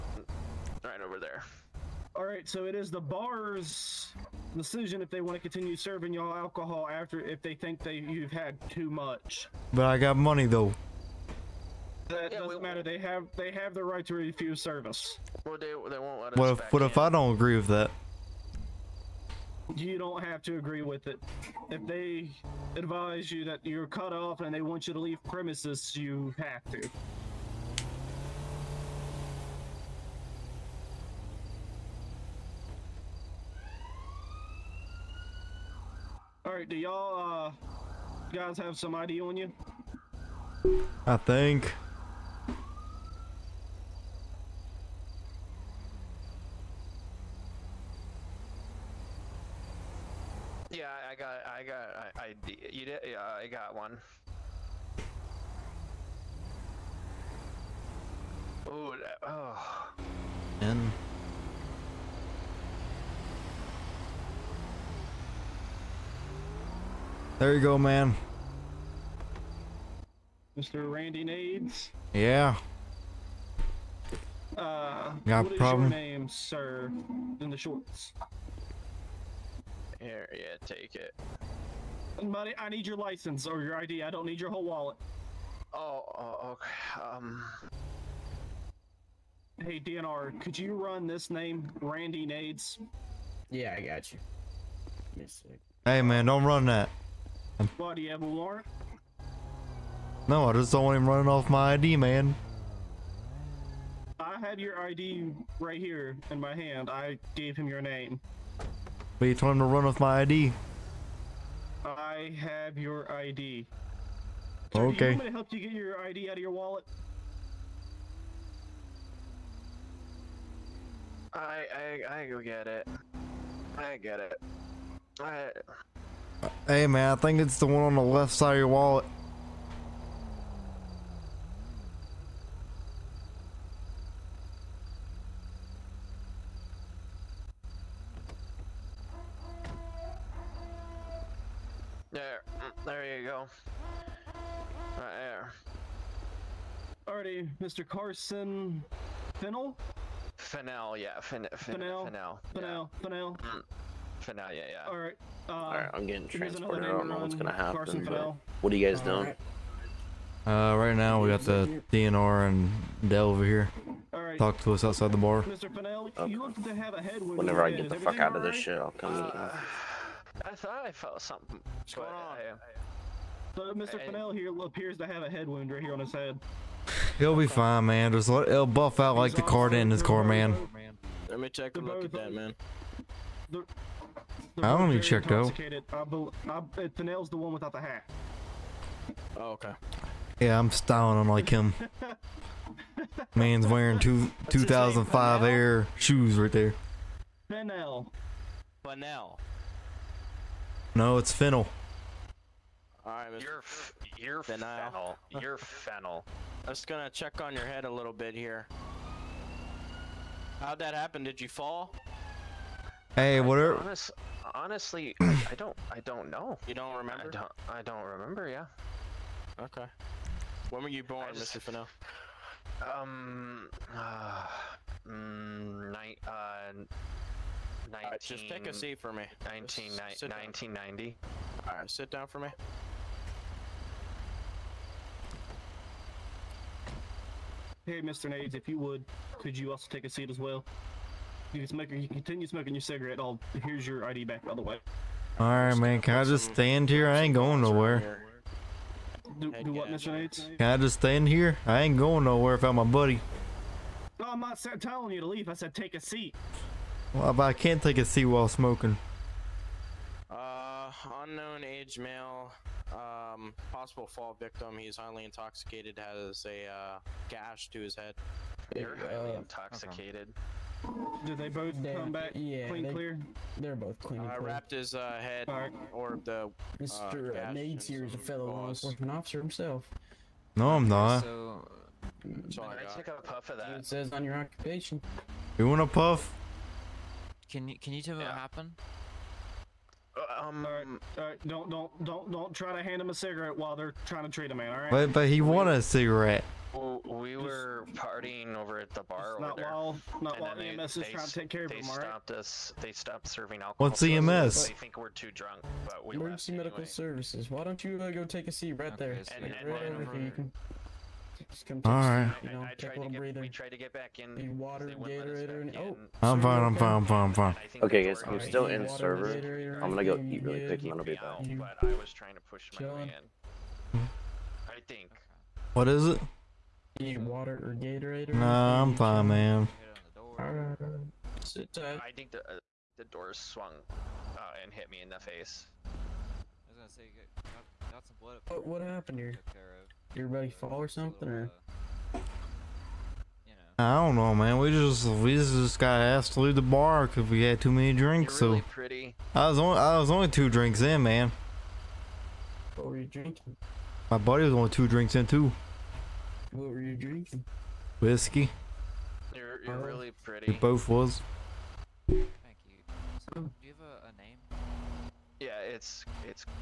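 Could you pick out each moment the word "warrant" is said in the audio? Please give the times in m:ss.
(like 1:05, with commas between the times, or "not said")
1:38.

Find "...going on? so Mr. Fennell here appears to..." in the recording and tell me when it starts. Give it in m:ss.
2:51.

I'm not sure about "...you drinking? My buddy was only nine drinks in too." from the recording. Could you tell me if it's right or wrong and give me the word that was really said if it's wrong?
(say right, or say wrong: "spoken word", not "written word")
wrong: "two", not "nine".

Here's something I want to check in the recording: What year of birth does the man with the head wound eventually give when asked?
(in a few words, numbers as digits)
1990.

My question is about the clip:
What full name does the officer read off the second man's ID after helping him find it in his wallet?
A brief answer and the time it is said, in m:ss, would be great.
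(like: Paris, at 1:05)
Carson Fennel, at 2:27.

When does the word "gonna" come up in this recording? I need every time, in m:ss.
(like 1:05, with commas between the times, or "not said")
2:37, 3:26, 5:19, 5:36.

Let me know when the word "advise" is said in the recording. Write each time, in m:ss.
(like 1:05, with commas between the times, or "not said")
0:22.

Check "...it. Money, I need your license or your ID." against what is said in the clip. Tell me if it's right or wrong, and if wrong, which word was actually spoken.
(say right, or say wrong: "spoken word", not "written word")
right.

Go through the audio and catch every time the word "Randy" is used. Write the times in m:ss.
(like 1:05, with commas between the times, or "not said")
1:10, 1:31.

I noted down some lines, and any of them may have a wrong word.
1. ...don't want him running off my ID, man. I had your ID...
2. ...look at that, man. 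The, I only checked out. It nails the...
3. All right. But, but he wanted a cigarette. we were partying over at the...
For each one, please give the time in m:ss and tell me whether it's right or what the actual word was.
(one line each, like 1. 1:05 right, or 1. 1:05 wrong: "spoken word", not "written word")
1. 1:40 right
2. 3:01 right
3. 4:54 right.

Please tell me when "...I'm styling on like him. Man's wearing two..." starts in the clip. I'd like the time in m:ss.
3:10.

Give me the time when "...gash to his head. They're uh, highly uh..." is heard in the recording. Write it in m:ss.
4:27.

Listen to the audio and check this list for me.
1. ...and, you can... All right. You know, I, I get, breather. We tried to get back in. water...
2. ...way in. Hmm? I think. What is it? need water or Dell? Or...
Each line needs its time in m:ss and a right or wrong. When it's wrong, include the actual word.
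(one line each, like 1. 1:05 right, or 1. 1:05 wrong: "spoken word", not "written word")
1. 5:09 right
2. 5:22 wrong: "Gatorade", not "Dell".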